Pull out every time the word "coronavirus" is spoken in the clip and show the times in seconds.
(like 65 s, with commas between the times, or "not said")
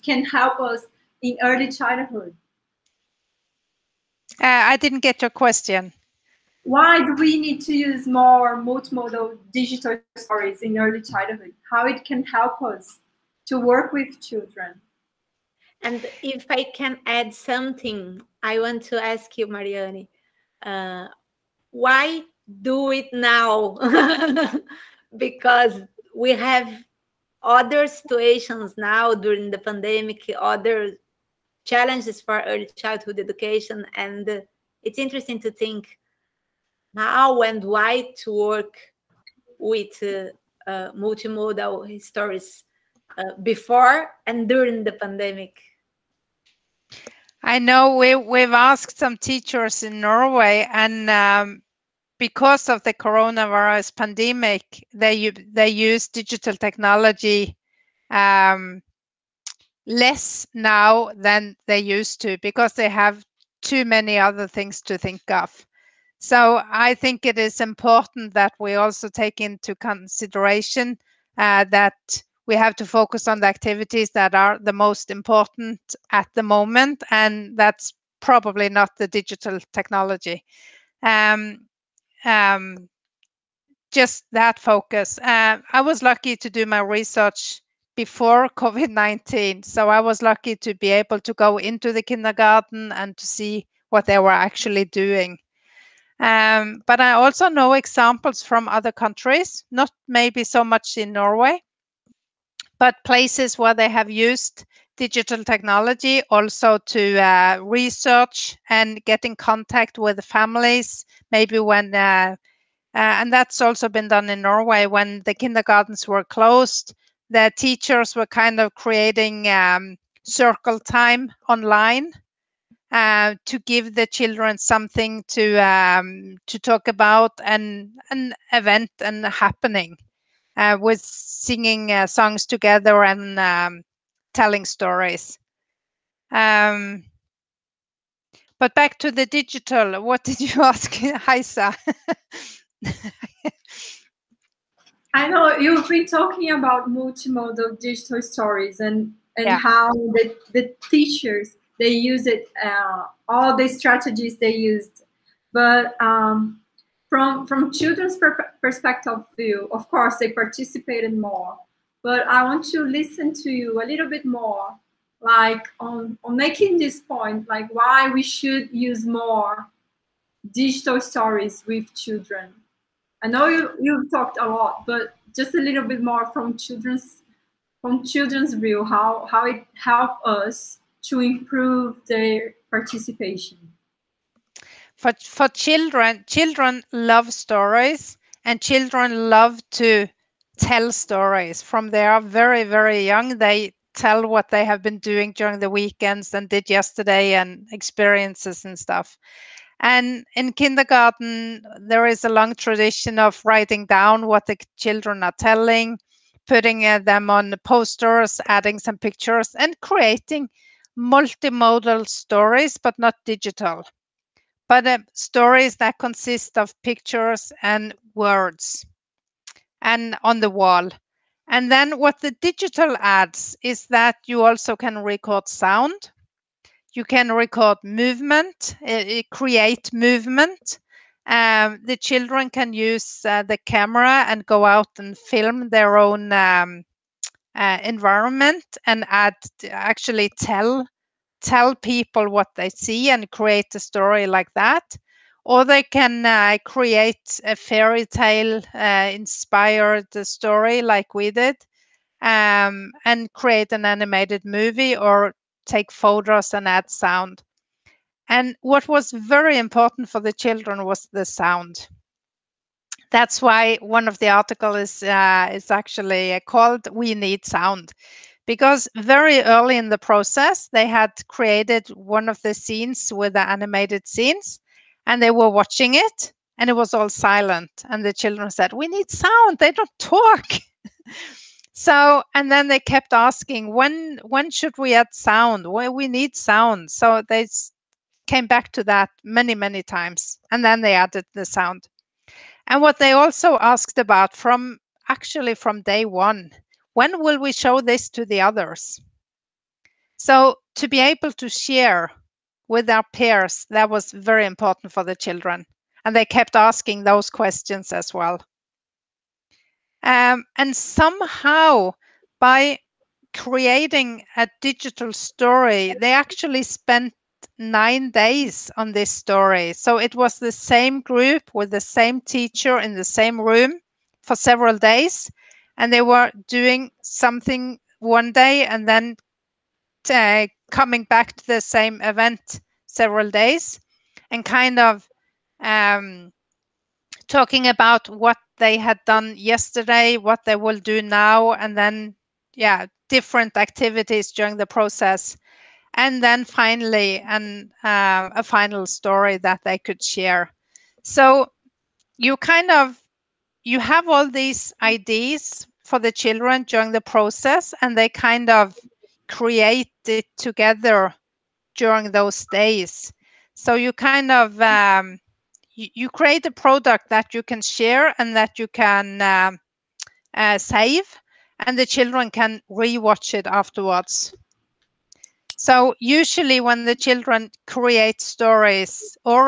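52 s.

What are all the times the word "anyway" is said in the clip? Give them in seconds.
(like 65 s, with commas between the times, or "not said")
not said.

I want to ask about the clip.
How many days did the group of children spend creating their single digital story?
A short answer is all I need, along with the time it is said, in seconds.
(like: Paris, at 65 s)
9, at 317 s.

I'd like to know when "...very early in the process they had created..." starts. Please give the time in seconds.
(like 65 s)
268 s.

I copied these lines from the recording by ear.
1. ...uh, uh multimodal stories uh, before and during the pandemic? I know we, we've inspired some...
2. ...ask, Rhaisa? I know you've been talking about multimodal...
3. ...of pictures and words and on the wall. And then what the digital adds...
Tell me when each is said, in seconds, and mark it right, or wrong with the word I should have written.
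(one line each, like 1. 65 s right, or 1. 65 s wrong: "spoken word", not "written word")
1. 40 s wrong: "asked", not "inspired"
2. 140 s right
3. 216 s right.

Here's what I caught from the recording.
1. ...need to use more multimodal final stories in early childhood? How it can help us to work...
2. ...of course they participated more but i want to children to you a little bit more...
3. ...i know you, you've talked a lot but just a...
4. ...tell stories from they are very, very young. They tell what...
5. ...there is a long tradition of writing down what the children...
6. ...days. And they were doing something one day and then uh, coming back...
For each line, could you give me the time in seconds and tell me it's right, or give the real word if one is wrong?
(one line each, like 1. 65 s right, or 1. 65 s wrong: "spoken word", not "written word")
1. 7 s wrong: "digital", not "final"
2. 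159 s wrong: "listen", not "children"
3. 173 s right
4. 190 s right
5. 201 s right
6. 324 s right.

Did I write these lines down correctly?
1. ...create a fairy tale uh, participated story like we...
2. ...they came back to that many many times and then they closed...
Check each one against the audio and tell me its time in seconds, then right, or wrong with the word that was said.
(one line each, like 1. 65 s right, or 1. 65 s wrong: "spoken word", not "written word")
1. 246 s wrong: "inspired", not "participated"
2. 287 s wrong: "added", not "closed".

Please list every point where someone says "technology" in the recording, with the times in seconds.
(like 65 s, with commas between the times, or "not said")
56 s, 79 s, 105 s.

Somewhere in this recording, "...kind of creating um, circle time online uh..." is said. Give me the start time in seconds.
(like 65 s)
118 s.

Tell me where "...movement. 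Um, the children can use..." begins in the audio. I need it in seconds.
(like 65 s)
229 s.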